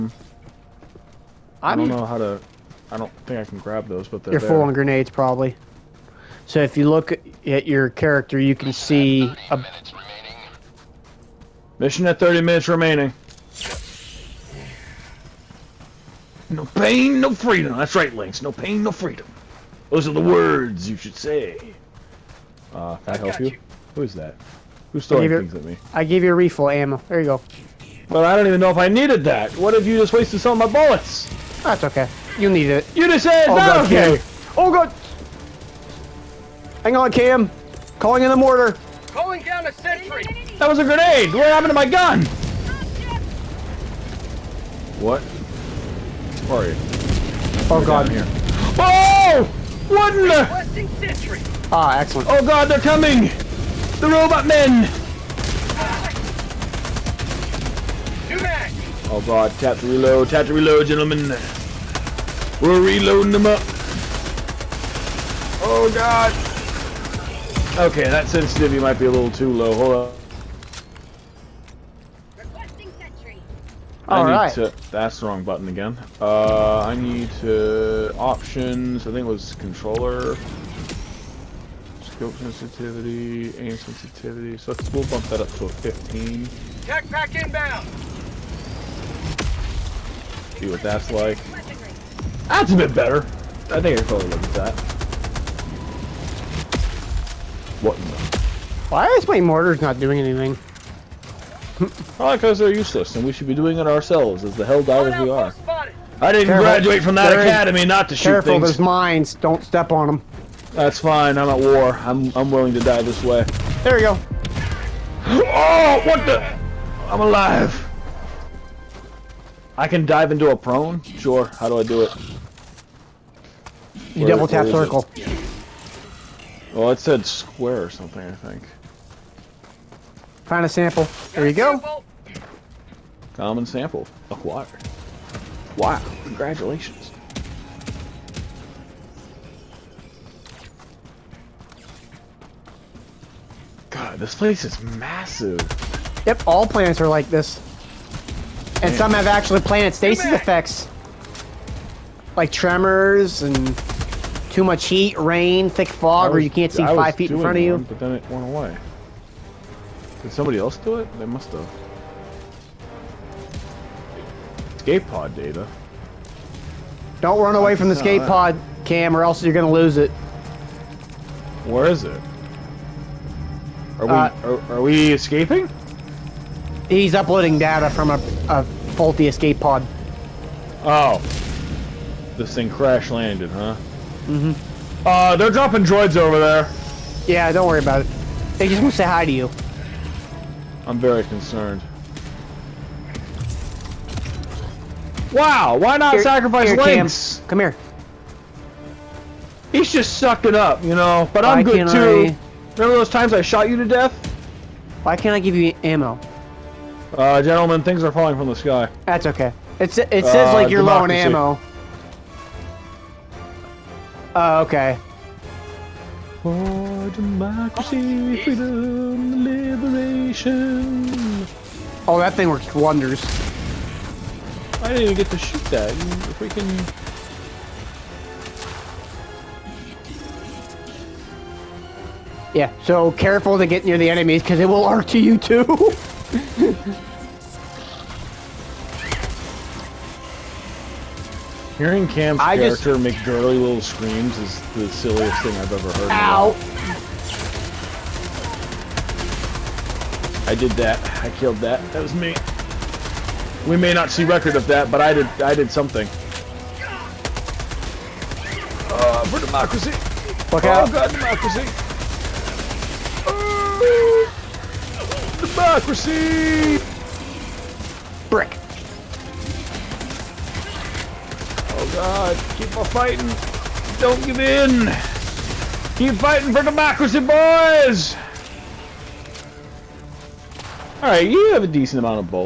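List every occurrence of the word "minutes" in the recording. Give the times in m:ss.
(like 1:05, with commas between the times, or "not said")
0:12.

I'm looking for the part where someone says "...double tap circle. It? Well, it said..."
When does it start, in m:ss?
2:04.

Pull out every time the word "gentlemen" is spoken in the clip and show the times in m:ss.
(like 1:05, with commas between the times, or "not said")
1:00, 3:27.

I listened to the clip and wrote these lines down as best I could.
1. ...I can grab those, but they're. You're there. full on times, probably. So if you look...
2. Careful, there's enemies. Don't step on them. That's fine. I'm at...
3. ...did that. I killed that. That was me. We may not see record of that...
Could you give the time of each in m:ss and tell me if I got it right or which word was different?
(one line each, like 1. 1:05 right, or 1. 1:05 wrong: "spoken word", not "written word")
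1. 0:03 wrong: "grenades", not "times"
2. 1:48 wrong: "mines", not "enemies"
3. 4:10 right.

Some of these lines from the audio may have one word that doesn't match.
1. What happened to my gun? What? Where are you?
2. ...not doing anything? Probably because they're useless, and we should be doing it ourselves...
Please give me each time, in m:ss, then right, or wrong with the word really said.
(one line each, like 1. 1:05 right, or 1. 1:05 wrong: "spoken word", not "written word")
1. 0:41 right
2. 1:39 right.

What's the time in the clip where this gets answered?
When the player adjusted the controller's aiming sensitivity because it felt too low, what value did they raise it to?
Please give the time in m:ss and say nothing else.
1:25.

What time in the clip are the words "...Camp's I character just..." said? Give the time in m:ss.
4:02.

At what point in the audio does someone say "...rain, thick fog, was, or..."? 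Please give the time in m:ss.
2:35.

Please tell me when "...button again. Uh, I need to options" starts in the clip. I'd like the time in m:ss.
1:15.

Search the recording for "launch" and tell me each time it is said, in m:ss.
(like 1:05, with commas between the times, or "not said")
not said.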